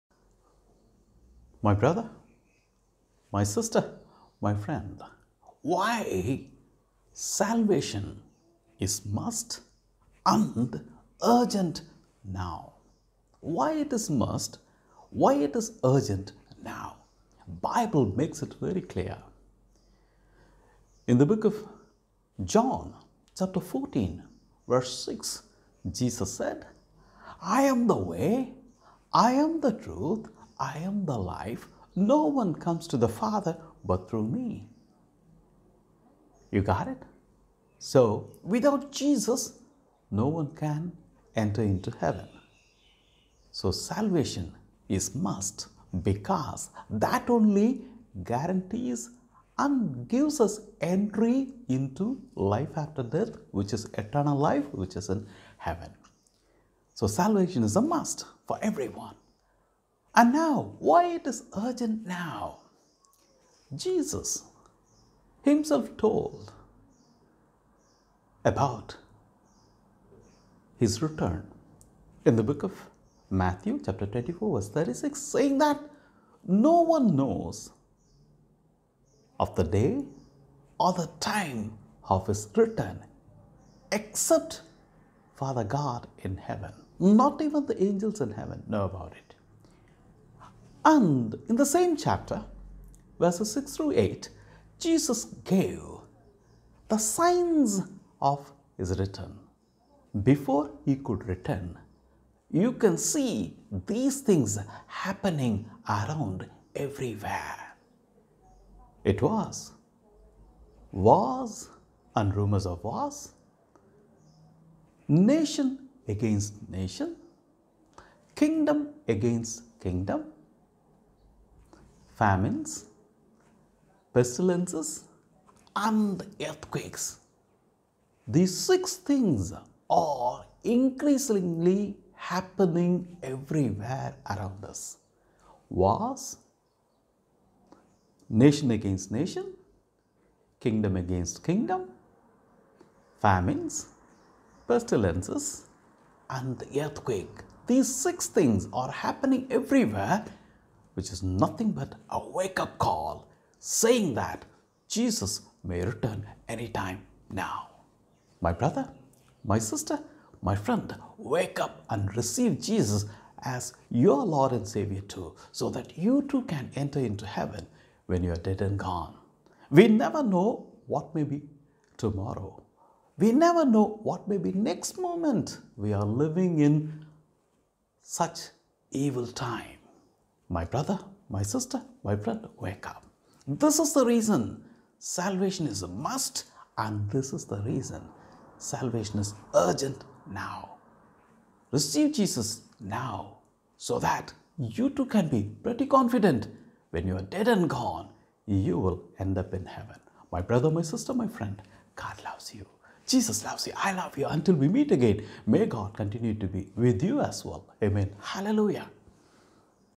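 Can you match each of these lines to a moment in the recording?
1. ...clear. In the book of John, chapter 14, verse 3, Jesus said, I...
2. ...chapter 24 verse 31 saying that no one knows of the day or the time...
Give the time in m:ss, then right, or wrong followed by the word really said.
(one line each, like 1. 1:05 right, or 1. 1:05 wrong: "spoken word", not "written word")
1. 0:18 wrong: "6", not "3"
2. 1:13 wrong: "36", not "31".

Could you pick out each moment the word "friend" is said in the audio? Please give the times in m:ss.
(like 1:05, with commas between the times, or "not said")
0:04, 2:40, 3:02, 3:21.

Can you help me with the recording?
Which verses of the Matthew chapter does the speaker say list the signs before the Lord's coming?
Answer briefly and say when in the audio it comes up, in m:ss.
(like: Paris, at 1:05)
6 through 8, at 1:33.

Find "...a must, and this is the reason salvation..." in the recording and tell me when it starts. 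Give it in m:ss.
3:05.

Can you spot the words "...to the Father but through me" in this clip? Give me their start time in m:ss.
0:32.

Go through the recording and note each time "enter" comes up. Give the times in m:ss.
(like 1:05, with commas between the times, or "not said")
0:41, 2:46.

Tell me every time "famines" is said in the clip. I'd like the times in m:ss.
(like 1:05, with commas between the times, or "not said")
2:02, 2:23.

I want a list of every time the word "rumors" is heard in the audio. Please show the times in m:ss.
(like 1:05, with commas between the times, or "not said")
1:52.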